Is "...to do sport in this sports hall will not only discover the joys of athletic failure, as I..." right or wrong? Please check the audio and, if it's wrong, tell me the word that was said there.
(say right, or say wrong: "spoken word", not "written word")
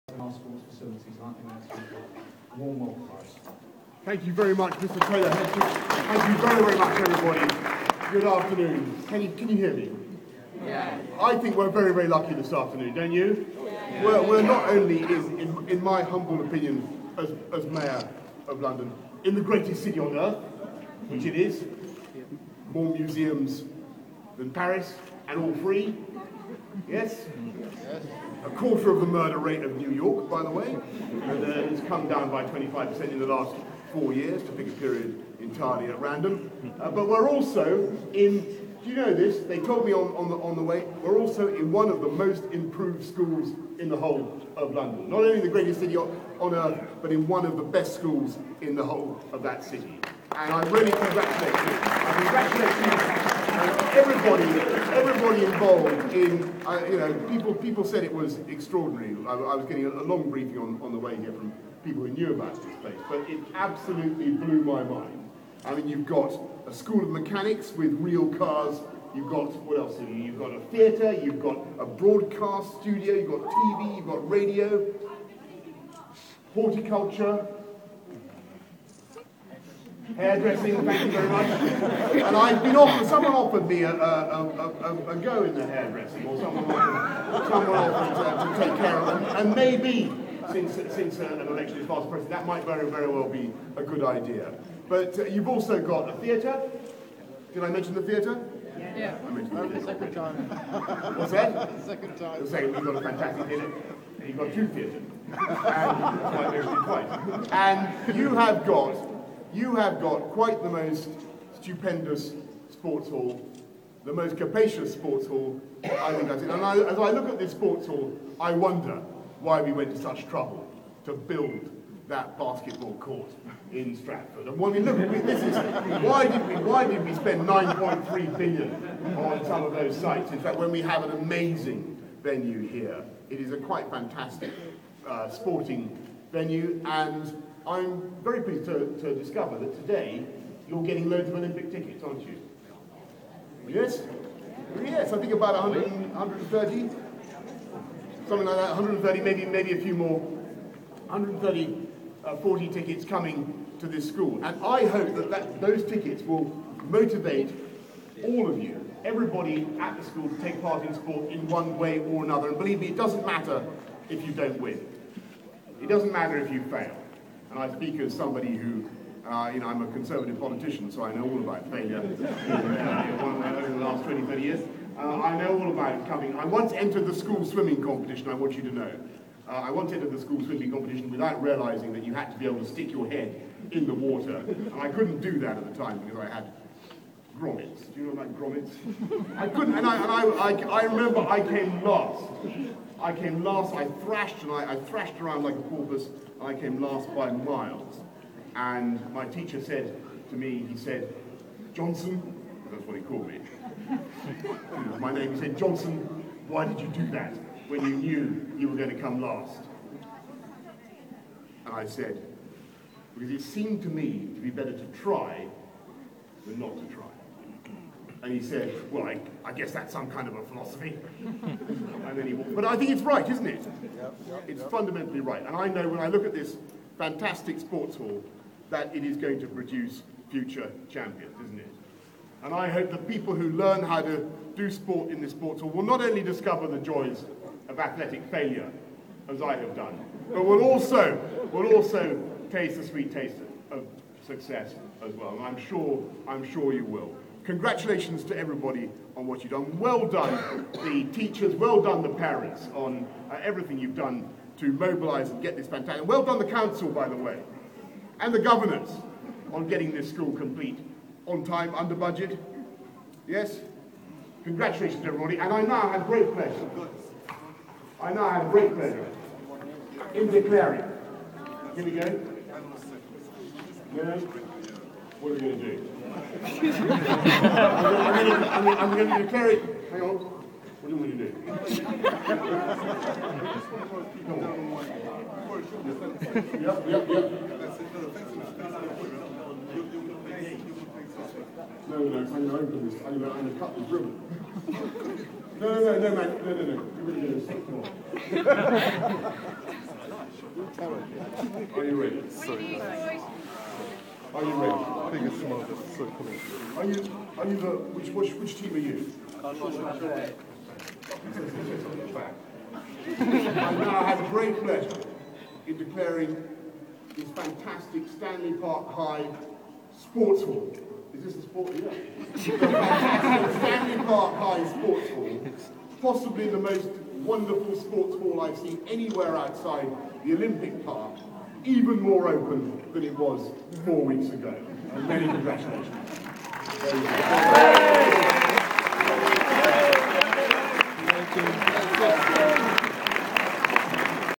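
right.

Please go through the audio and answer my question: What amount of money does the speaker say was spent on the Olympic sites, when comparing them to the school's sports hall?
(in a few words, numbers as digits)
9.3 billion.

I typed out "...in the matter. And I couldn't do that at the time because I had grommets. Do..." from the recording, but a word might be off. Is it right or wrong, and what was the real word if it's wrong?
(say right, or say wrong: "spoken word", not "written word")
wrong: "water", not "matter".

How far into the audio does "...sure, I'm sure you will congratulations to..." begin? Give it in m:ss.
4:05.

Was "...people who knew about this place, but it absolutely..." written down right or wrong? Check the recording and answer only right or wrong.
right.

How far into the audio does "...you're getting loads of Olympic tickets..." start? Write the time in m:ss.
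2:20.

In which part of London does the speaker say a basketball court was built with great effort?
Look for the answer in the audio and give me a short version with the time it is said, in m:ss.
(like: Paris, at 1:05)
Stratford, at 2:03.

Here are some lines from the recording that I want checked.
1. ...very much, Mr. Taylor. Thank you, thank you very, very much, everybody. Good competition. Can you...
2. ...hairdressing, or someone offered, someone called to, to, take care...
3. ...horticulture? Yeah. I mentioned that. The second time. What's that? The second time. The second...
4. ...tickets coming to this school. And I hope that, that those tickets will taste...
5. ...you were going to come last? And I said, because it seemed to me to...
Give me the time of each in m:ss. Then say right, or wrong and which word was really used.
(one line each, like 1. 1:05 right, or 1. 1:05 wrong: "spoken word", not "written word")
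1. 0:04 wrong: "afternoon", not "competition"
2. 1:25 wrong: "offered", not "called"
3. 1:38 wrong: "theatre", not "horticulture"
4. 2:32 wrong: "motivate", not "taste"
5. 3:28 right.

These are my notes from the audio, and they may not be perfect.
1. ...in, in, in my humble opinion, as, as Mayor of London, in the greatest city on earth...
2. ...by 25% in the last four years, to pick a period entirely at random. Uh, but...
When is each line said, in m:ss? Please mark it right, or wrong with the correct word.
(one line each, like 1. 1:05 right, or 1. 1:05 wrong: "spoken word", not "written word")
1. 0:15 right
2. 0:32 right.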